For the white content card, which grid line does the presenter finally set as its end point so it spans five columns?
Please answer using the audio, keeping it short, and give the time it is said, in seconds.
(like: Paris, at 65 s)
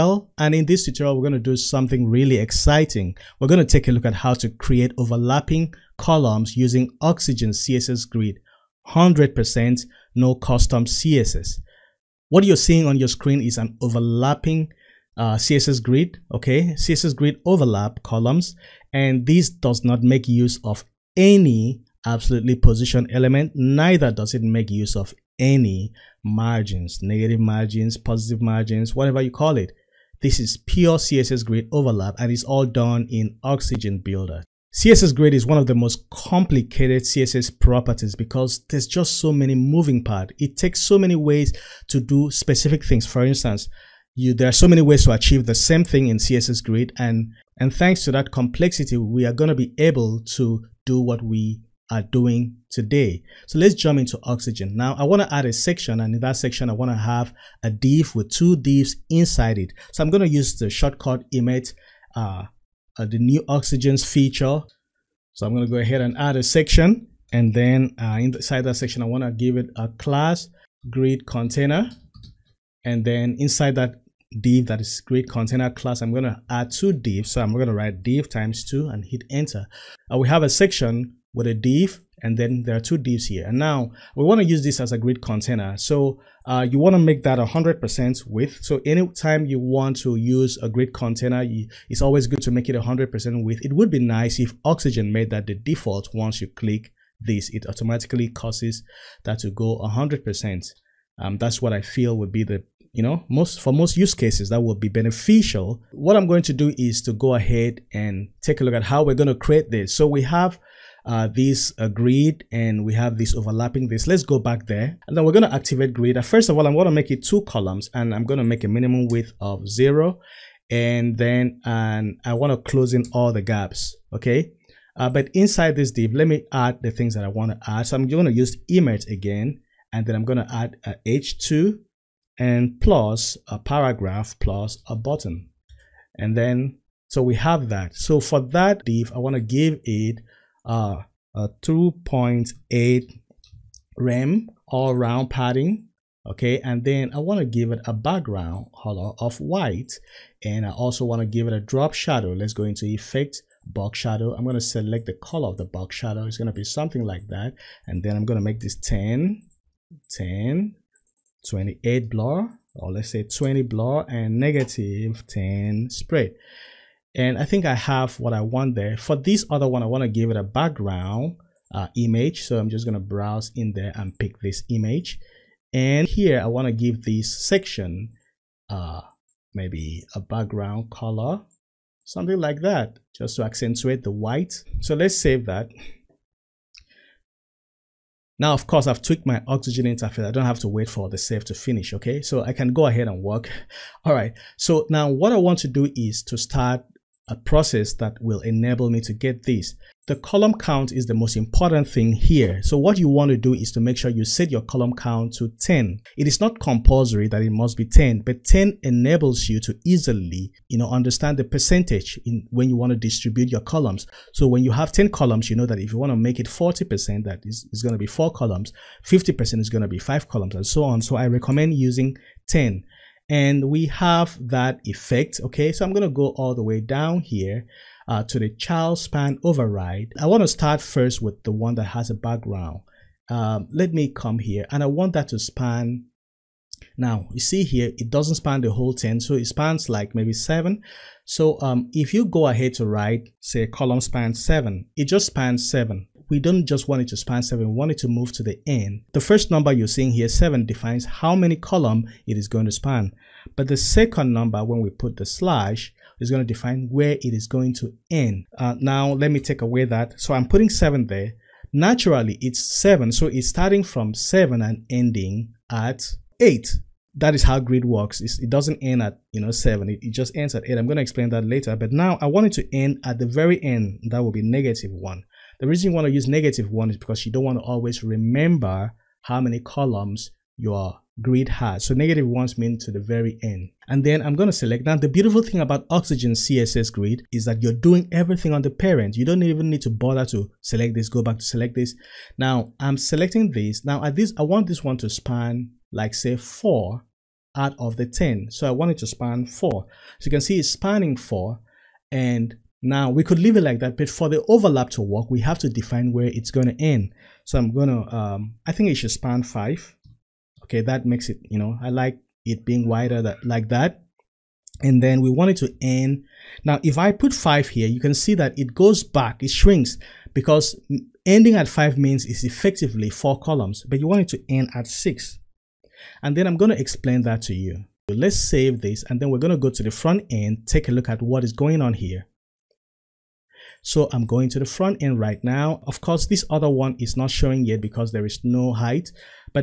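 6, at 324 s.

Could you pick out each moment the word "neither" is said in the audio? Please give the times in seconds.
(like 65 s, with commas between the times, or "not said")
23 s.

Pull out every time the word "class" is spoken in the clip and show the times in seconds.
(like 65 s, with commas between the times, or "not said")
69 s, 75 s.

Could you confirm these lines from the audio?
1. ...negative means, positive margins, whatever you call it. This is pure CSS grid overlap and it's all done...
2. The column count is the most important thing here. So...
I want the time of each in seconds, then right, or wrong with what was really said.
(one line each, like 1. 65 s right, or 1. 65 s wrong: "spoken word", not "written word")
1. 27 s wrong: "margins", not "means"
2. 200 s right.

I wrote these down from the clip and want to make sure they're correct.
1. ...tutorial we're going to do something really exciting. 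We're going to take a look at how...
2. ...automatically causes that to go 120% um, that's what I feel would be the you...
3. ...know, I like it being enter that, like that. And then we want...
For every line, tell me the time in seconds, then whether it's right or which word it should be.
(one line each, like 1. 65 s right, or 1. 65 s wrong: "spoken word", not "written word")
1. 0 s right
2. 97 s wrong: "100", not "120"
3. 311 s wrong: "wider", not "enter".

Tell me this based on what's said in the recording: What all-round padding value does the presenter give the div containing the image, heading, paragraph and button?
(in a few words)
2.8 rem.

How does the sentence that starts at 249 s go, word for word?
The first number you're seeing here, 7, defines how many column it is going to span.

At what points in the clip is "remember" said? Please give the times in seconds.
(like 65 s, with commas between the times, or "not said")
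278 s.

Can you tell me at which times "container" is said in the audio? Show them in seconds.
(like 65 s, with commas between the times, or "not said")
71 s, 75 s, 85 s, 90 s.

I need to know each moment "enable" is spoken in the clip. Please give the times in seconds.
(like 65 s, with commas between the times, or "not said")
198 s, 208 s.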